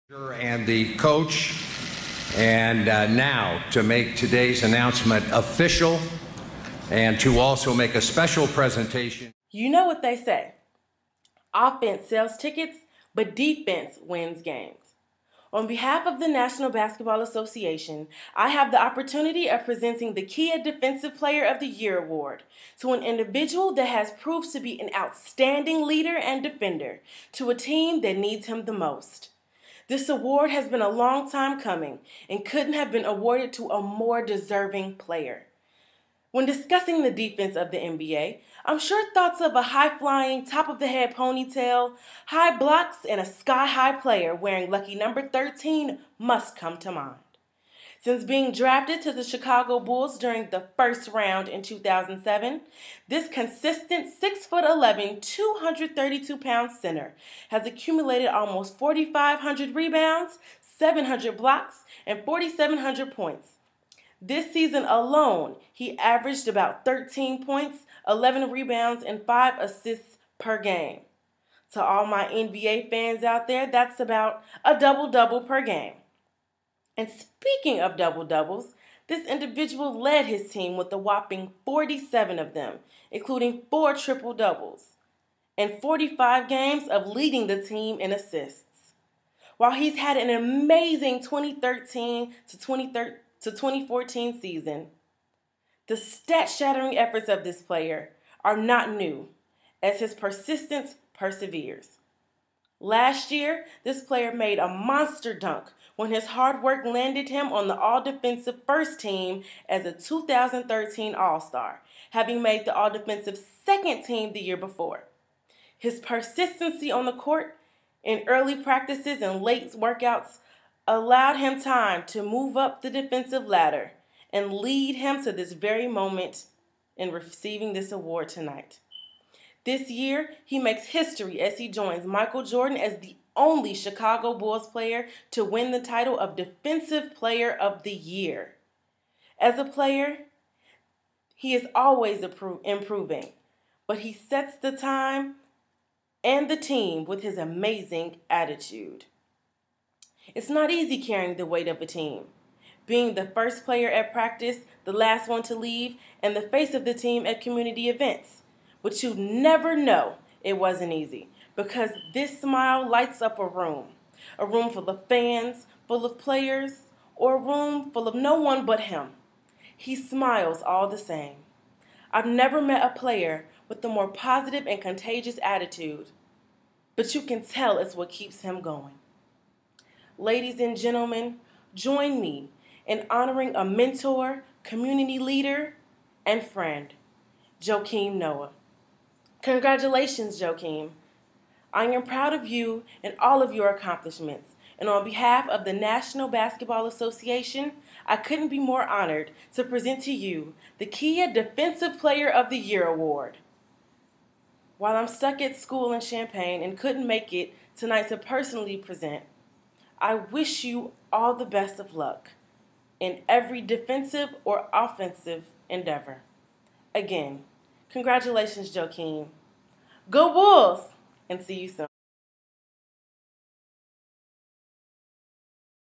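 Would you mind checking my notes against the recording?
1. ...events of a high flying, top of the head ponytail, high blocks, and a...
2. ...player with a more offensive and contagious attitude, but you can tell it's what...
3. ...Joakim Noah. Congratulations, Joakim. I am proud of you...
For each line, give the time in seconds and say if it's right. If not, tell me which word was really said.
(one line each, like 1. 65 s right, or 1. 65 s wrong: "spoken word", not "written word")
1. 39 s wrong: "thoughts", not "events"
2. 172 s wrong: "positive", not "offensive"
3. 187 s right.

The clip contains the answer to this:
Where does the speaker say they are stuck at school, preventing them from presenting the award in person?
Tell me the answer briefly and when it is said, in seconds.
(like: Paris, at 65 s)
Champaign, at 206 s.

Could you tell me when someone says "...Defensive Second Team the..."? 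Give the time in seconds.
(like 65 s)
112 s.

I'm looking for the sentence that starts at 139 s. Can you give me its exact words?
As a player, he is always improving, but he sets the time and the team with his amazing attitude.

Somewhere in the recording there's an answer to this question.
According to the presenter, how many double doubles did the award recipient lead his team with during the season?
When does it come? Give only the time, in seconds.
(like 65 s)
81 s.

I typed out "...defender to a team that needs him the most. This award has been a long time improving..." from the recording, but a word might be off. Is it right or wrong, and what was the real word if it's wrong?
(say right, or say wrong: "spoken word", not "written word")
wrong: "coming", not "improving".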